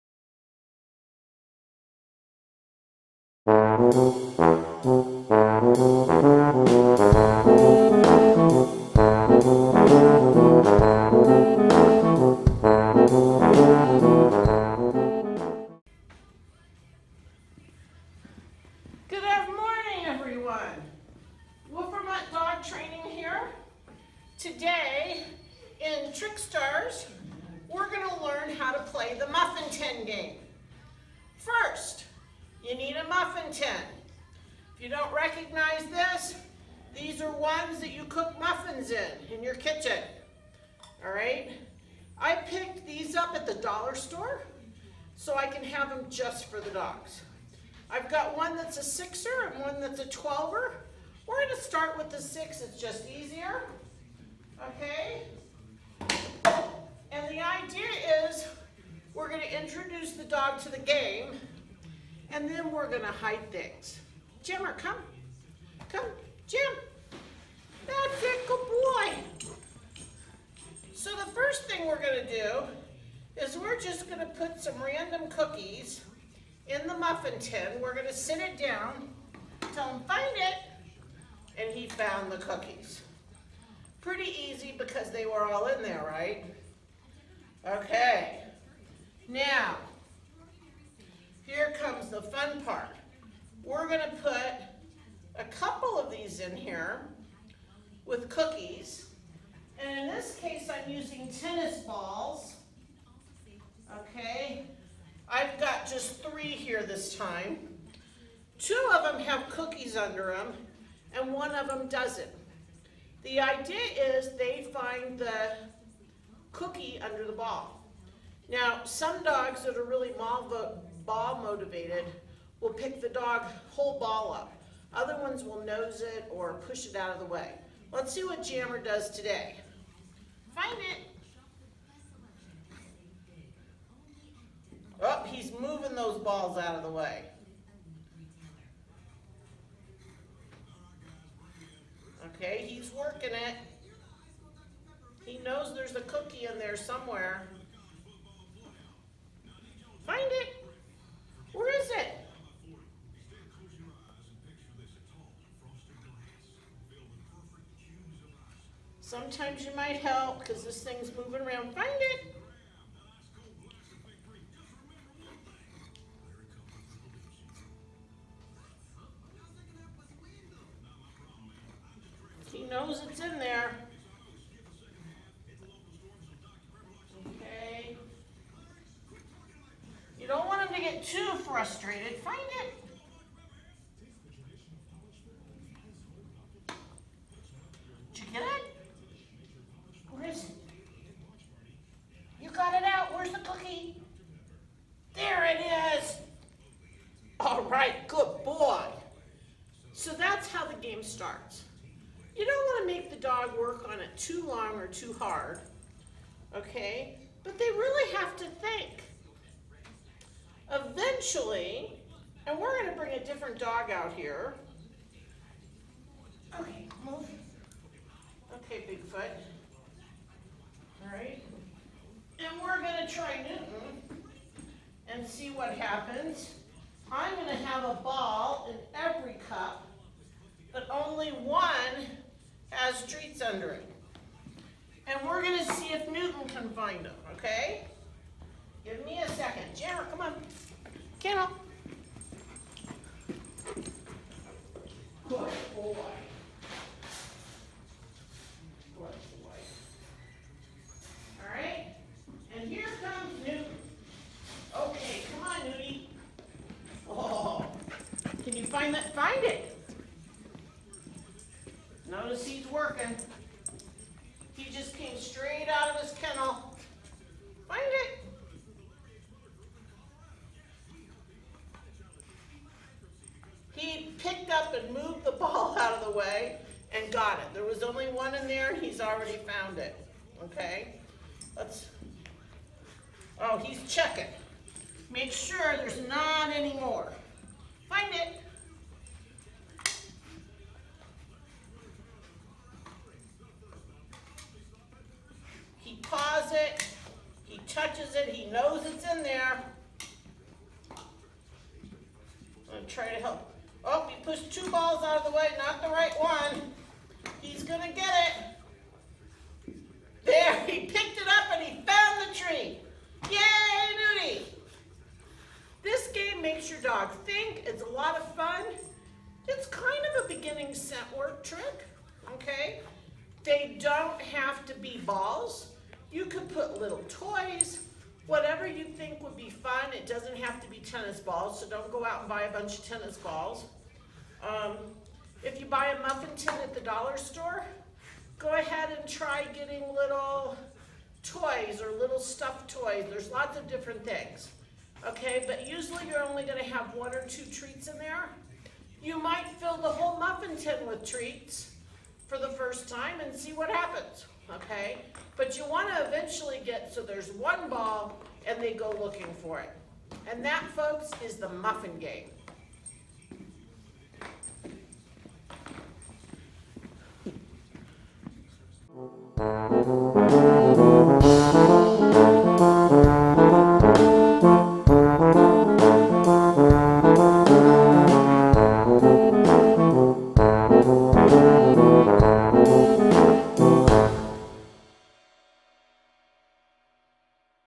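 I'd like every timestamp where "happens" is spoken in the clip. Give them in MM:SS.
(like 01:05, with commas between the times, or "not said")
03:45, 05:53.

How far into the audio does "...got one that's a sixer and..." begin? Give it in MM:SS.
00:48.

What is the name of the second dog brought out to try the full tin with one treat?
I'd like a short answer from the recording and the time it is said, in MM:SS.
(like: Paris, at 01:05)
Newton, at 03:56.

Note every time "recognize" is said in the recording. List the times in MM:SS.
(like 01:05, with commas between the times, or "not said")
00:35.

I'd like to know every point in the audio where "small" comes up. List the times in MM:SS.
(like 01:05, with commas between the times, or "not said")
not said.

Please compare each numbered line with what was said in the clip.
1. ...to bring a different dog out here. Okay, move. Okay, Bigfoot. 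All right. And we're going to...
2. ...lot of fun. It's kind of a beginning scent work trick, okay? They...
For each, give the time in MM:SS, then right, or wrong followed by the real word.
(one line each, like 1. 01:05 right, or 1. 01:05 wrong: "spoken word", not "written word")
1. 03:32 right
2. 05:17 right.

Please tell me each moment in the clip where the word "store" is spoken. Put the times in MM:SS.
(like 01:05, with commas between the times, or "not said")
00:43, 05:37.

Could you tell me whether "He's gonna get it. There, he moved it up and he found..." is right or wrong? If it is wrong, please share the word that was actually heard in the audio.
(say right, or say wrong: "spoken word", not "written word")
wrong: "picked", not "moved".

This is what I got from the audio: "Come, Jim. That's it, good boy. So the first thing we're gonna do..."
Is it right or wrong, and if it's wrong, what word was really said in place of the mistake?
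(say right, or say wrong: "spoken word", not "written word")
right.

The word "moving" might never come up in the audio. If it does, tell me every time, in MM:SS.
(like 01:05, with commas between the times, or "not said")
02:15, 02:41.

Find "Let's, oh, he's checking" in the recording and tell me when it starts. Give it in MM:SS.
04:41.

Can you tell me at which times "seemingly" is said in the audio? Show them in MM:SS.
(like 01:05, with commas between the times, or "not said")
not said.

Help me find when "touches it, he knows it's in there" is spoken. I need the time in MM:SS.
04:57.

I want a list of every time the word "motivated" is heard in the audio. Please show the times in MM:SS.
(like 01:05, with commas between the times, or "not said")
02:01.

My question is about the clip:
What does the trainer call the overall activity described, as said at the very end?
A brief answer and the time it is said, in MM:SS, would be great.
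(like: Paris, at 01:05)
the muffin game, at 06:01.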